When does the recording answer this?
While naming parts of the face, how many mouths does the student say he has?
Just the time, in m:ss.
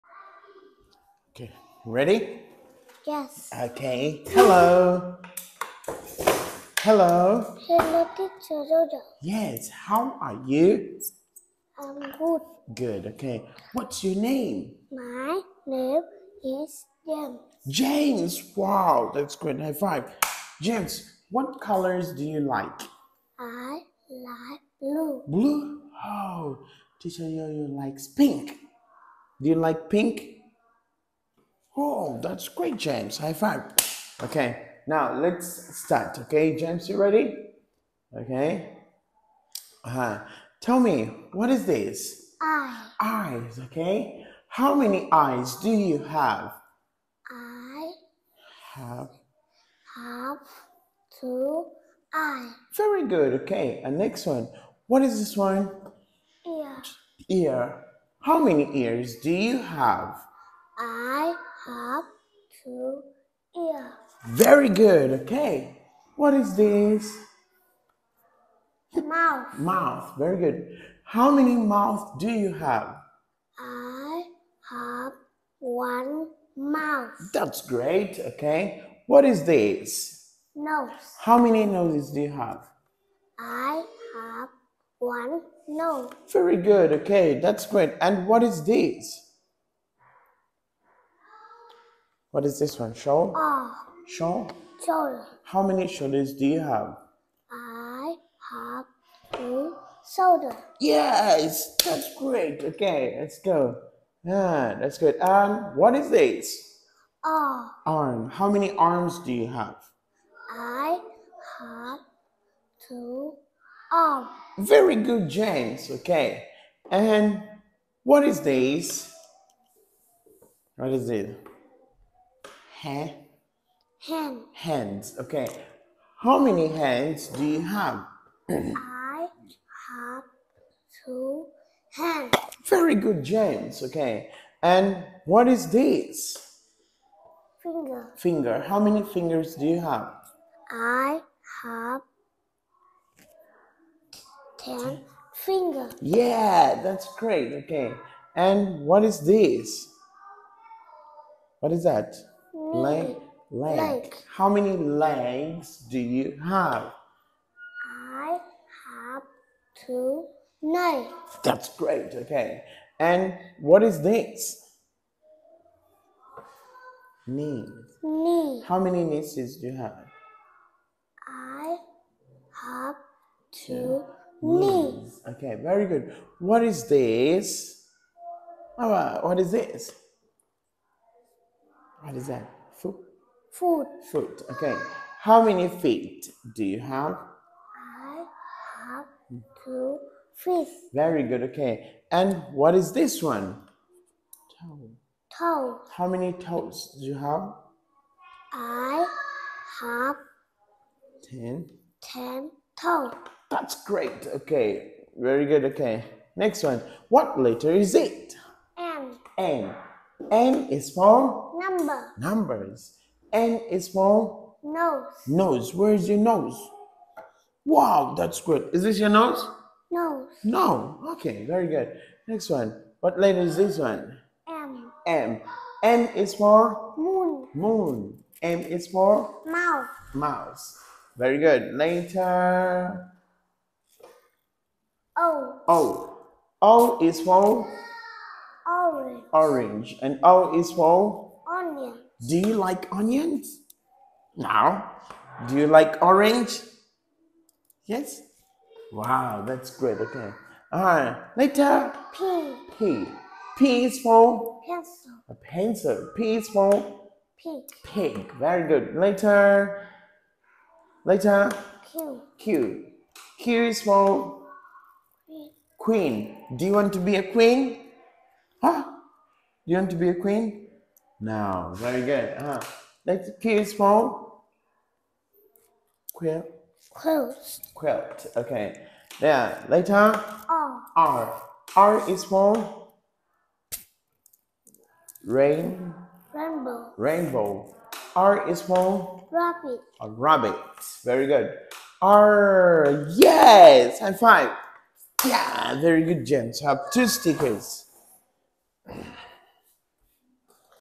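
1:13.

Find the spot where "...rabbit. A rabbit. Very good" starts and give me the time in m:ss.
4:49.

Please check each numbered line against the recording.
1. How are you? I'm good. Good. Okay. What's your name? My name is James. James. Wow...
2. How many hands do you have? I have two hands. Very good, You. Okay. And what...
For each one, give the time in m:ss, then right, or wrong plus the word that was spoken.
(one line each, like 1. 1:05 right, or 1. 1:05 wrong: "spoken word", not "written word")
1. 0:09 right
2. 2:06 wrong: "James", not "You".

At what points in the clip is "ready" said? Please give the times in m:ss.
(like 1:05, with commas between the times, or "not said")
0:01, 0:36.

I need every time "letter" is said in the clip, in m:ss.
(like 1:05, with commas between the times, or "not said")
3:27, 3:43.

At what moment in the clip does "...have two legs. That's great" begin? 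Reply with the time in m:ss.
2:38.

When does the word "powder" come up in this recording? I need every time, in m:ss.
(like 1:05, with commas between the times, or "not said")
not said.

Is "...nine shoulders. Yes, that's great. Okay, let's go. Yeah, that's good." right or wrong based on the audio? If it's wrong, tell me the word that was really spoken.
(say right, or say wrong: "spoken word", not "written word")
wrong: "two", not "nine".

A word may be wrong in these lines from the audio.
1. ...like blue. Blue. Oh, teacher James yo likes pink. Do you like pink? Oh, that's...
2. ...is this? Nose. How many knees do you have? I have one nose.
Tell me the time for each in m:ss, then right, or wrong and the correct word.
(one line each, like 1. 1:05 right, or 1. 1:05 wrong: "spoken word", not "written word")
1. 0:24 wrong: "You", not "James"
2. 1:19 wrong: "noses", not "knees".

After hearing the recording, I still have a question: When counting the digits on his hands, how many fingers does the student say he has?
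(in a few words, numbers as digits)
10.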